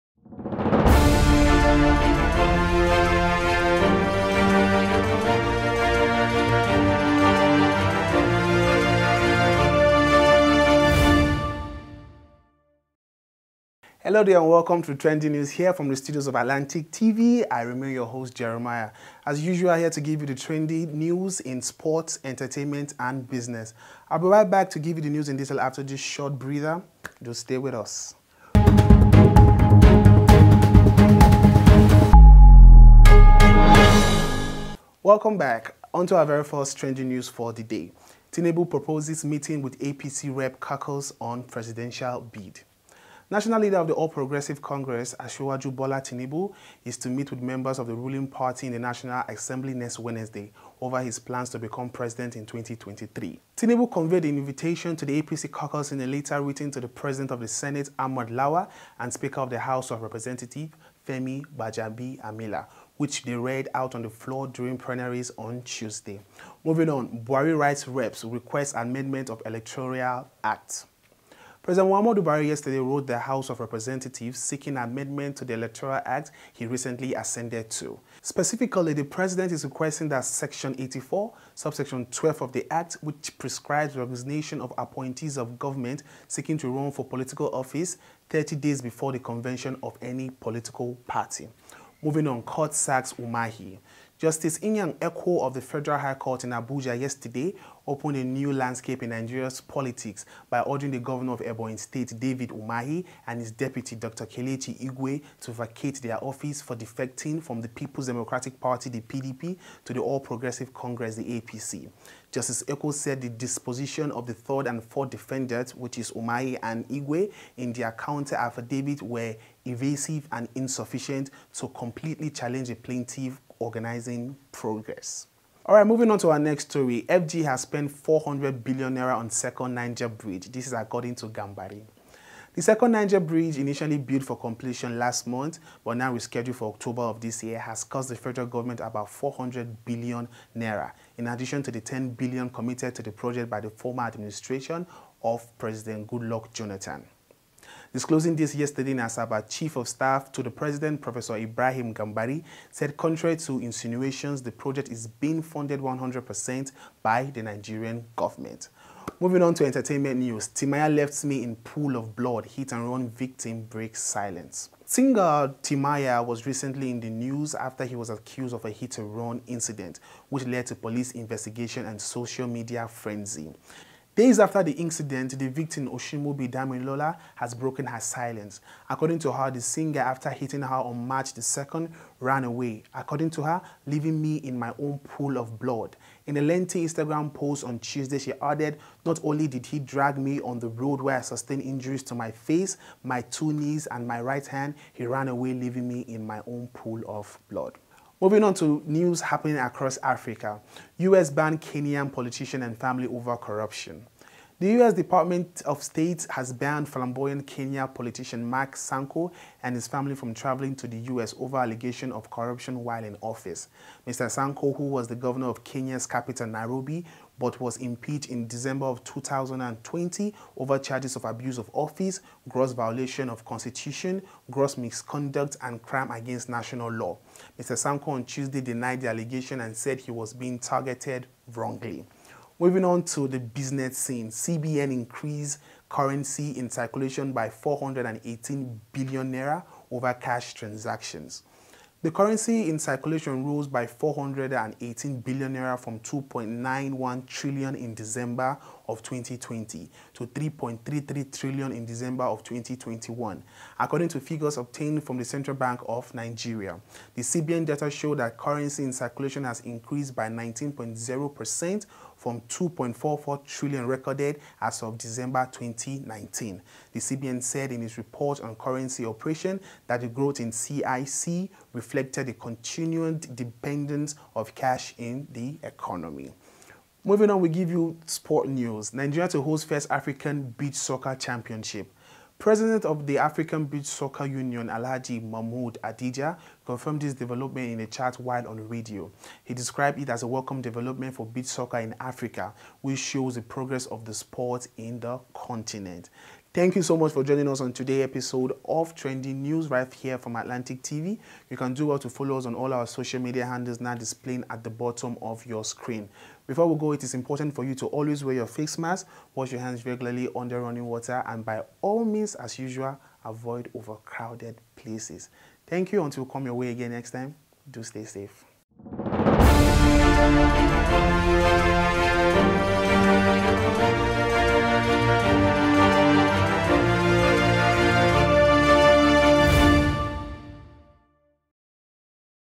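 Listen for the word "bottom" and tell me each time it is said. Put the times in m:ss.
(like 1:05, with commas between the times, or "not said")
5:04.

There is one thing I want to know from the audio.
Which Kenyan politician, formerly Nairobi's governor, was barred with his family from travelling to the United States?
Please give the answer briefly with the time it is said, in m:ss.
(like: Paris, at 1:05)
Mark Sonko, at 3:28.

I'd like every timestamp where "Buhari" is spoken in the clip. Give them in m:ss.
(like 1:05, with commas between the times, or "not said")
1:07, 1:12.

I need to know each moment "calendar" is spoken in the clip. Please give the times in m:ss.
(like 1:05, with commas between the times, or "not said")
not said.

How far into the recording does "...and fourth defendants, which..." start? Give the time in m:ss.
1:54.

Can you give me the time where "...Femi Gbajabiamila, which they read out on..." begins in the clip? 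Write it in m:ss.
1:01.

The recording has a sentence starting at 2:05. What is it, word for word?
All right, moving on to our next story.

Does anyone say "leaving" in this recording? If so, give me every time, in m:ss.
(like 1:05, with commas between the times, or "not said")
3:03, 3:15.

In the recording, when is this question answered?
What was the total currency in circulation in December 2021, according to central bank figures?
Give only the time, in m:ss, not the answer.
4:10.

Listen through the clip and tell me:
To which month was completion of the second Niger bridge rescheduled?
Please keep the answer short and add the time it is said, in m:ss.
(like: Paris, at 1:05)
October, at 2:16.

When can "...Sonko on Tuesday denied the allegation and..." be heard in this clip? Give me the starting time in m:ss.
3:47.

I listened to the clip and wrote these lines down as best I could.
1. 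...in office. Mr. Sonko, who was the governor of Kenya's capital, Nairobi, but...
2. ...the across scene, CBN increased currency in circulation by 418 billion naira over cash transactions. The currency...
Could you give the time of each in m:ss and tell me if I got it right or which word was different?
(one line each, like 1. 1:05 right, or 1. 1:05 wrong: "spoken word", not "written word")
1. 3:33 right
2. 3:53 wrong: "business", not "across".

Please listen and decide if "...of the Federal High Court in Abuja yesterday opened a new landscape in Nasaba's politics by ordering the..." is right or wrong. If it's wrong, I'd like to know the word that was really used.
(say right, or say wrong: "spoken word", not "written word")
wrong: "Nigeria", not "Nasaba".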